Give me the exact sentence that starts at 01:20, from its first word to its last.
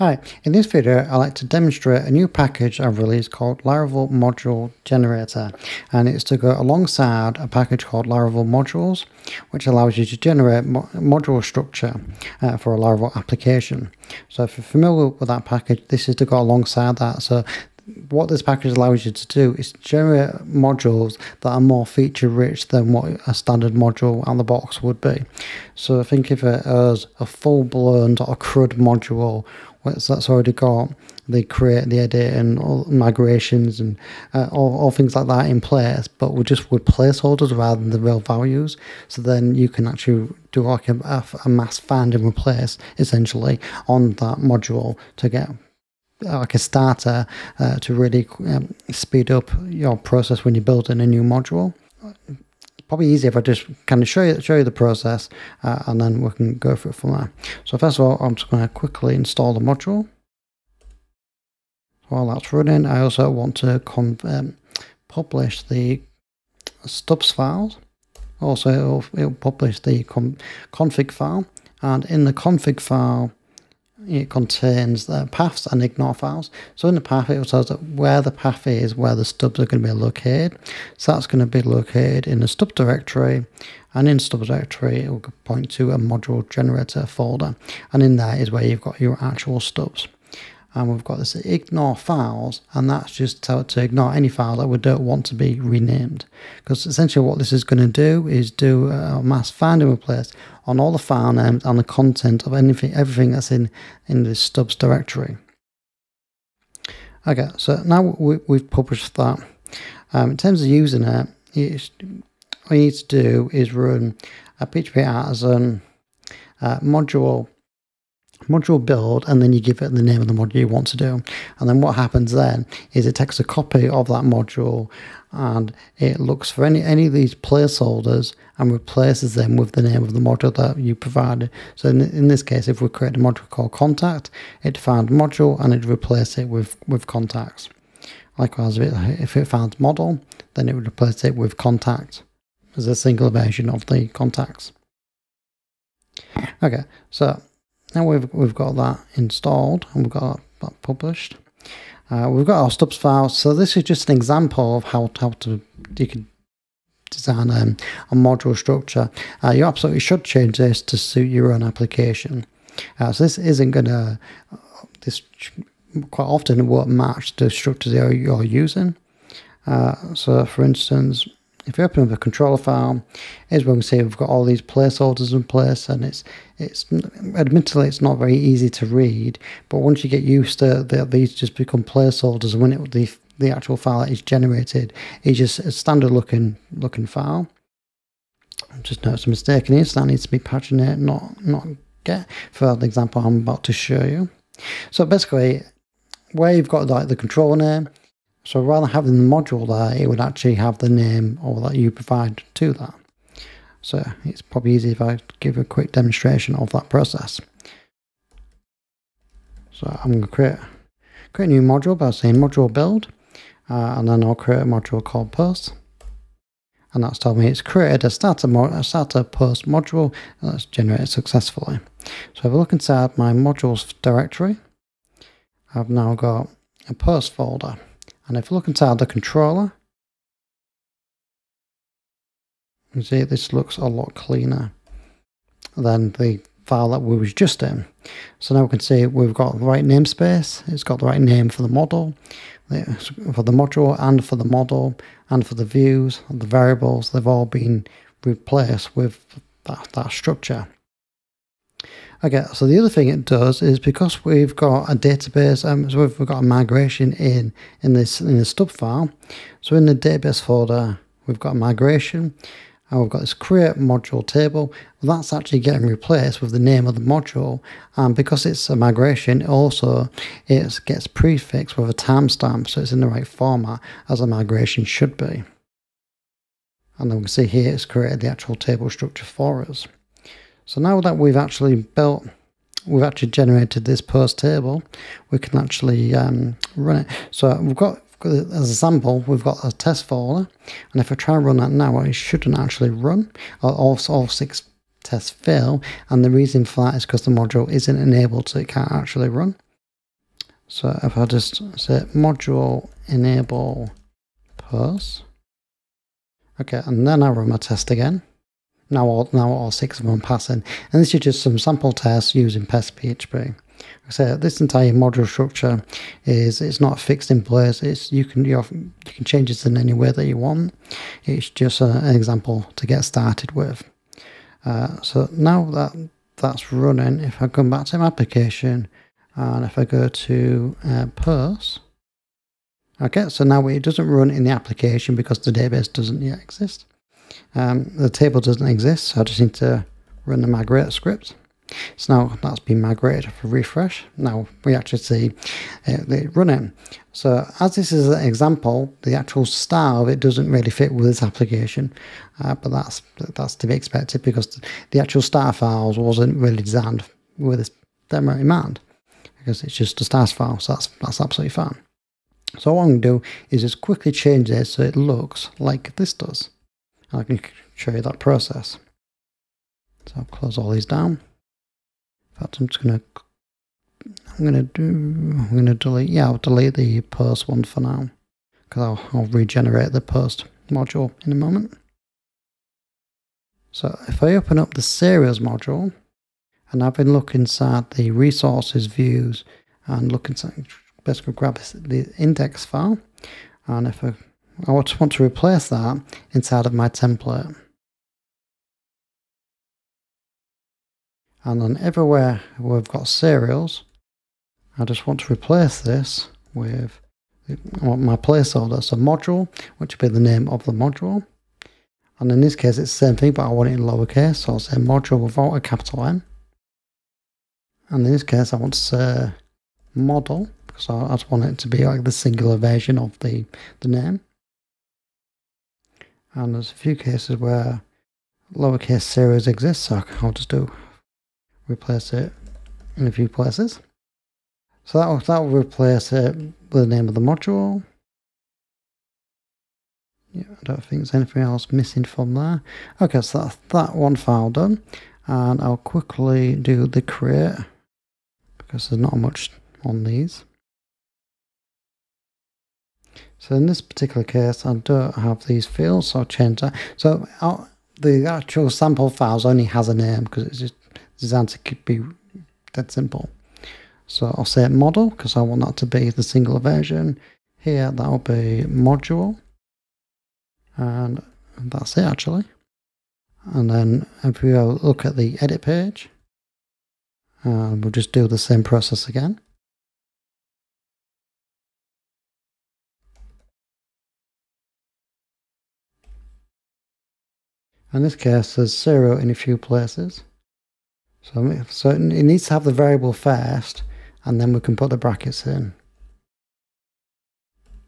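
So that's going to be located in the stub directory.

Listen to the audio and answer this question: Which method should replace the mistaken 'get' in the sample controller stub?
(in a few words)
paginate.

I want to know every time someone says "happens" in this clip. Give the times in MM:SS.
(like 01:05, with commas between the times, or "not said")
02:01.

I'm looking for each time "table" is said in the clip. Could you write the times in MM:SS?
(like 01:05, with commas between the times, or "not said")
04:24, 04:38, 04:44, 05:38.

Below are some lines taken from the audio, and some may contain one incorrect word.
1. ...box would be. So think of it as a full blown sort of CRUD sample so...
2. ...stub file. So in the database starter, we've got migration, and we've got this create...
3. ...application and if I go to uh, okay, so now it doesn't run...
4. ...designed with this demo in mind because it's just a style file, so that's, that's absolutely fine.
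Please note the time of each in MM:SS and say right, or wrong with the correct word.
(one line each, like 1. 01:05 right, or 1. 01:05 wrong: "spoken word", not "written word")
1. 00:24 wrong: "module", not "sample"
2. 04:18 wrong: "folder", not "starter"
3. 05:28 right
4. 05:56 right.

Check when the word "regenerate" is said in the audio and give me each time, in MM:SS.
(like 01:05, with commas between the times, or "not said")
06:19.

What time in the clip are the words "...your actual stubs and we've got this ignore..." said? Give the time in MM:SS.
01:29.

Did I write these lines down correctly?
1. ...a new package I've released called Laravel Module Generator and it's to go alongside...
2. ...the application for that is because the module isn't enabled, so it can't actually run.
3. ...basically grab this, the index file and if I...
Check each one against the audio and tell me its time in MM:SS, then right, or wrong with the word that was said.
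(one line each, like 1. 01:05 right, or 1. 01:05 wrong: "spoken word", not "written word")
1. 00:02 right
2. 04:56 wrong: "reason", not "application"
3. 06:31 right.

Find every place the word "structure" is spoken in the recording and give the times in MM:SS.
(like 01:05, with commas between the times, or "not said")
00:11, 02:38, 02:47, 04:10, 04:38, 05:15.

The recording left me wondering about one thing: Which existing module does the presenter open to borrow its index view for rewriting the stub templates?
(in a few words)
series.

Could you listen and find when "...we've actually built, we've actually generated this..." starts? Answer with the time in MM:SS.
04:41.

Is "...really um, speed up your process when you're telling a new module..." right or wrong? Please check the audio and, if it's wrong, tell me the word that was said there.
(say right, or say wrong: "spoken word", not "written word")
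wrong: "building", not "telling".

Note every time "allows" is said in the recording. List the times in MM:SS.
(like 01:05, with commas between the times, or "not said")
00:09, 00:18.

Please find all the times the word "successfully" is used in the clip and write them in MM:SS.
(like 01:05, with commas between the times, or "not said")
03:41.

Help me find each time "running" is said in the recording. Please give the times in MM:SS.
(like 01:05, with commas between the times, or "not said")
01:02, 05:26, 05:46.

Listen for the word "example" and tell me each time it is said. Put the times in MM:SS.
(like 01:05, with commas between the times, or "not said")
02:34, 03:12, 05:22, 05:48.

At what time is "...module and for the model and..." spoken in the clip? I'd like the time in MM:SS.
04:03.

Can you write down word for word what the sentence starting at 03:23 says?
So it's probably easy if I give a quick demonstration of that process.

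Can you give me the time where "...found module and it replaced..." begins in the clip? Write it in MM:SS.
02:14.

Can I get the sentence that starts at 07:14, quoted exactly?
So that will, that will replace it with the name of the module.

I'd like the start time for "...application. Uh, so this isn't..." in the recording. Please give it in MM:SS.
02:41.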